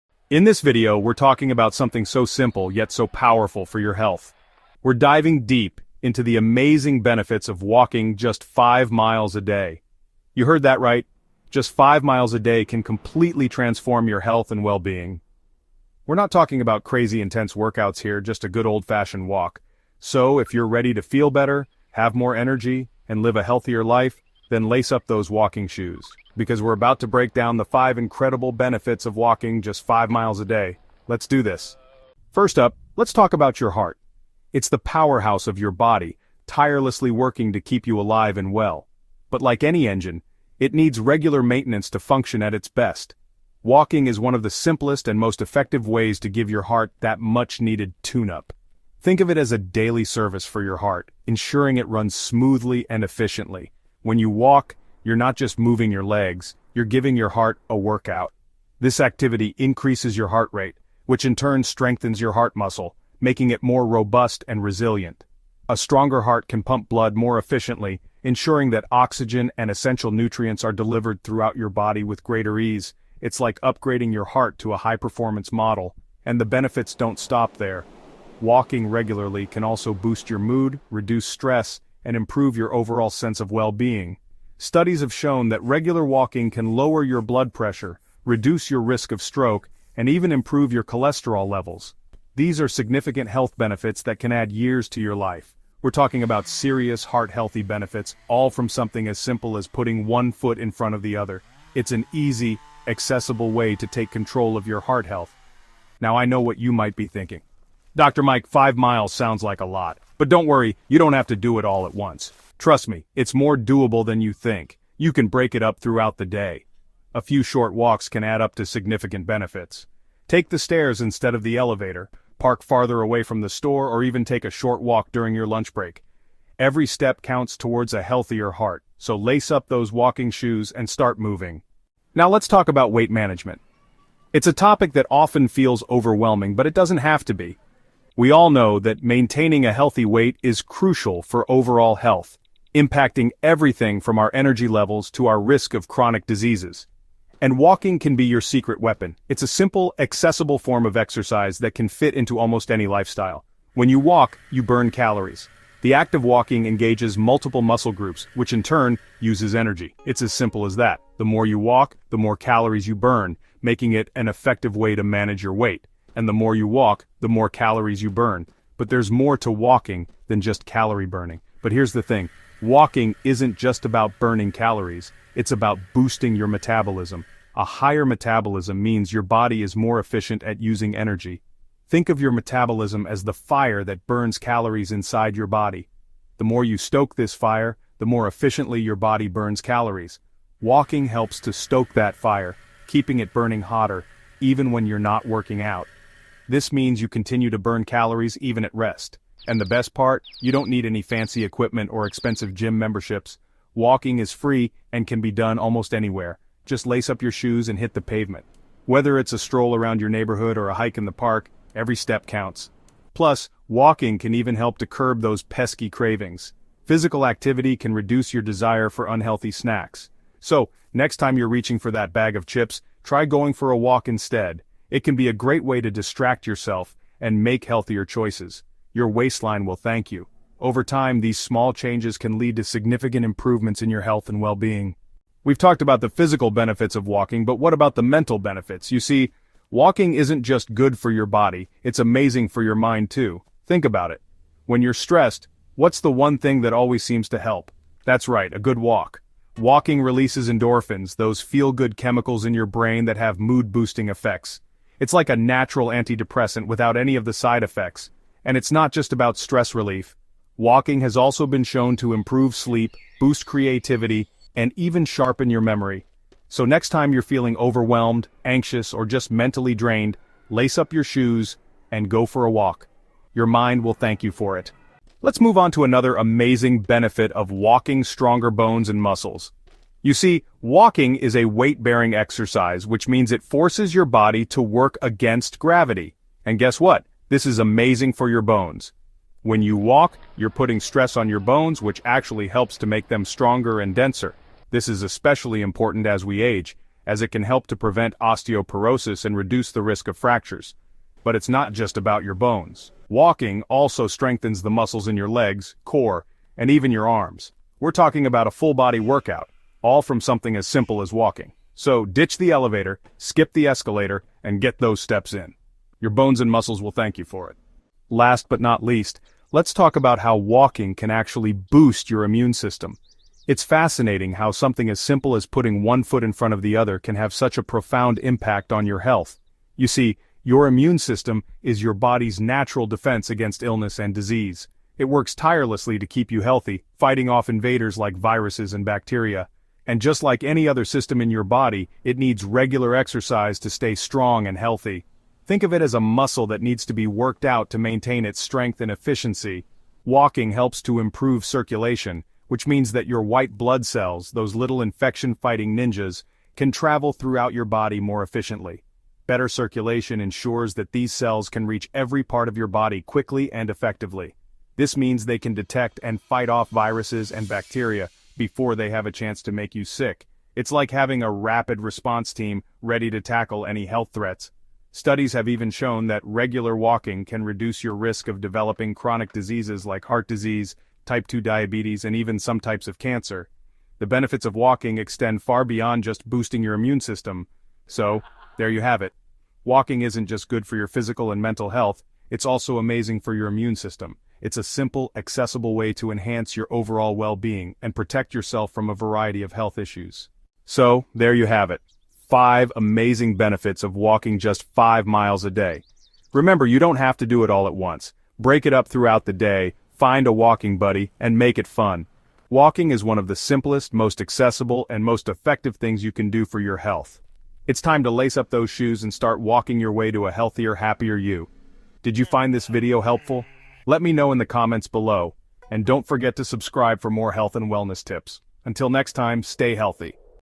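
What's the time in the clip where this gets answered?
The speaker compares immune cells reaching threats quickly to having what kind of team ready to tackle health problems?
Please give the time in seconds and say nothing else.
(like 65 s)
371 s.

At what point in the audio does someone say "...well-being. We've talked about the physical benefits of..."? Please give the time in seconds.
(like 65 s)
234 s.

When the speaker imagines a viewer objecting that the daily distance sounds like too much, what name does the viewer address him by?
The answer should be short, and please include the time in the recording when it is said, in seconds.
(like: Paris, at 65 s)
Dr. Mike, at 107 s.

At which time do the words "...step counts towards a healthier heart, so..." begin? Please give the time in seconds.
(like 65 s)
126 s.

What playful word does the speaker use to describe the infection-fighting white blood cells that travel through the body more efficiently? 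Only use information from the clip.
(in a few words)
ninjas.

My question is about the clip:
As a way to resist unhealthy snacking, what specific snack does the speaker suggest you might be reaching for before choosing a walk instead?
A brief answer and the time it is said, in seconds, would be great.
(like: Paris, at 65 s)
bag of chips, at 222 s.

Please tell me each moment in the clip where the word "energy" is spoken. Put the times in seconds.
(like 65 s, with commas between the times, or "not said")
22 s, 144 s, 159 s, 180 s.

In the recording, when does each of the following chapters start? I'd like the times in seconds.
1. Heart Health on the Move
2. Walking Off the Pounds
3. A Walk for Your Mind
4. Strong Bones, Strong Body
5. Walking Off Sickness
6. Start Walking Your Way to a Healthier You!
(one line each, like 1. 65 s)
1. 32 s
2. 131 s
3. 235 s
4. 274 s
5. 317 s
6. 400 s.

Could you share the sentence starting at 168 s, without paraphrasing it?
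But there's more to walking than just calorie burning.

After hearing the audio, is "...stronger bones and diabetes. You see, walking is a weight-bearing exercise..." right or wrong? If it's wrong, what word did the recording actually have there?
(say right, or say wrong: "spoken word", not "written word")
wrong: "muscles", not "diabetes".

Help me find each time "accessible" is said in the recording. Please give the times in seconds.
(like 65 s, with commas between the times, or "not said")
102 s, 149 s, 395 s, 414 s.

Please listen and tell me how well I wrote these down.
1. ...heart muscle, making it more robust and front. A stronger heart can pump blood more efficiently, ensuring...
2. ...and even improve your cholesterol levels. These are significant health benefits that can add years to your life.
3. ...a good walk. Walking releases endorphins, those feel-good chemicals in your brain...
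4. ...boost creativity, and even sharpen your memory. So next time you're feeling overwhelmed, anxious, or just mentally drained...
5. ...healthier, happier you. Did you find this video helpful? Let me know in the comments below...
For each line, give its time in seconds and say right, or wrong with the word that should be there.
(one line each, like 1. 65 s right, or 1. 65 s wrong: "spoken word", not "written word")
1. 62 s wrong: "resilient", not "front"
2. 89 s right
3. 248 s right
4. 263 s right
5. 420 s right.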